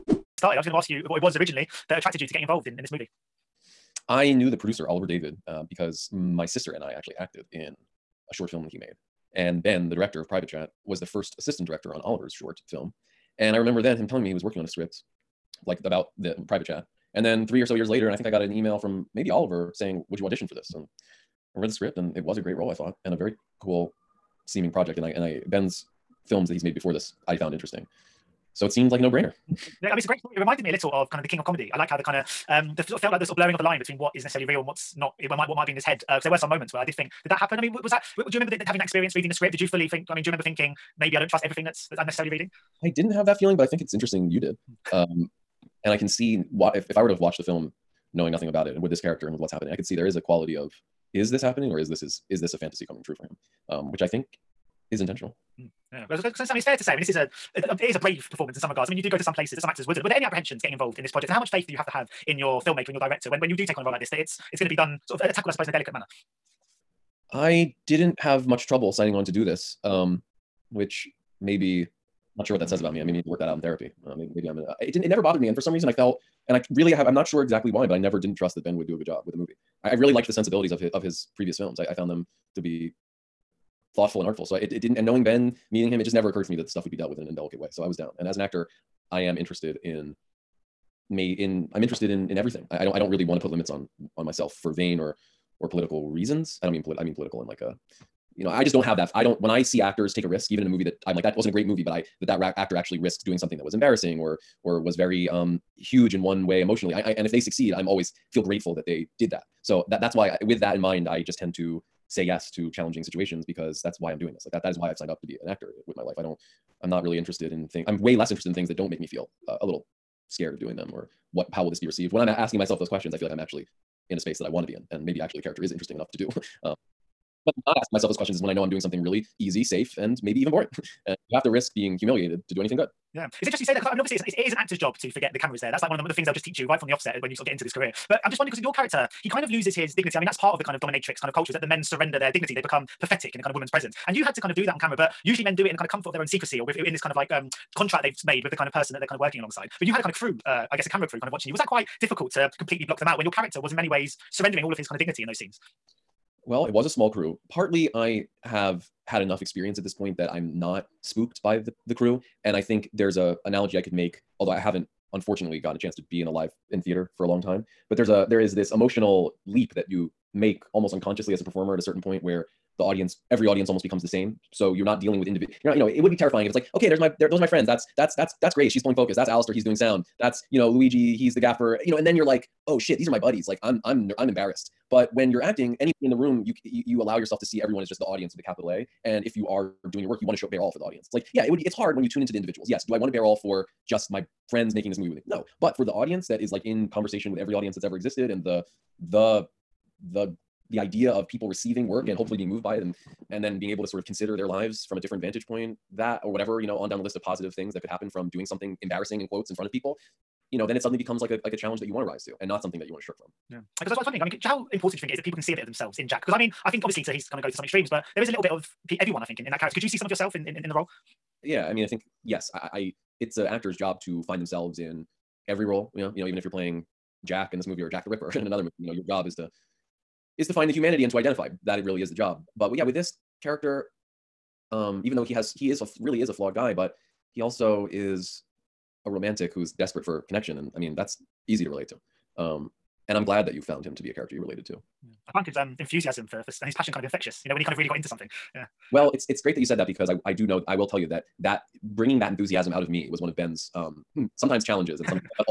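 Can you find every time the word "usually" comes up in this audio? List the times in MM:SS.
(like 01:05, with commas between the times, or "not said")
02:25.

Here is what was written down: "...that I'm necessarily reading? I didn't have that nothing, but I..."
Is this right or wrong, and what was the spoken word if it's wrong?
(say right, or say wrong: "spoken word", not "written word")
wrong: "feeling", not "nothing".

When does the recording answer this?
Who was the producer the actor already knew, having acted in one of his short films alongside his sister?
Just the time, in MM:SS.
00:04.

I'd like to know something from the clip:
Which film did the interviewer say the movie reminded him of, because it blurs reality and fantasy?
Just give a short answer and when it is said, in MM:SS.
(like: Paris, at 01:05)
The King of Comedy, at 00:31.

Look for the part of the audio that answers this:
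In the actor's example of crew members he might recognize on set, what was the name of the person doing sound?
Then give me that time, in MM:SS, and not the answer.
02:59.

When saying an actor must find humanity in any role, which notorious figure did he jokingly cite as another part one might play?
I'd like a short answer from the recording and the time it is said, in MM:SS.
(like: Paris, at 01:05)
Jack the Ripper, at 03:47.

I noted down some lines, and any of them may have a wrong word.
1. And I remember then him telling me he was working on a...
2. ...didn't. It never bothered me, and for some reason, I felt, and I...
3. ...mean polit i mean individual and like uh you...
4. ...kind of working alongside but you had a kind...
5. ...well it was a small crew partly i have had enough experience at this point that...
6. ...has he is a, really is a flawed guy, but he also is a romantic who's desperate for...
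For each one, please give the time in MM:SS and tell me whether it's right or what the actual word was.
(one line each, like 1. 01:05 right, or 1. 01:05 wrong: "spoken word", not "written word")
1. 00:13 right
2. 01:14 right
3. 01:36 wrong: "political", not "individual"
4. 02:29 right
5. 02:36 right
6. 03:55 right.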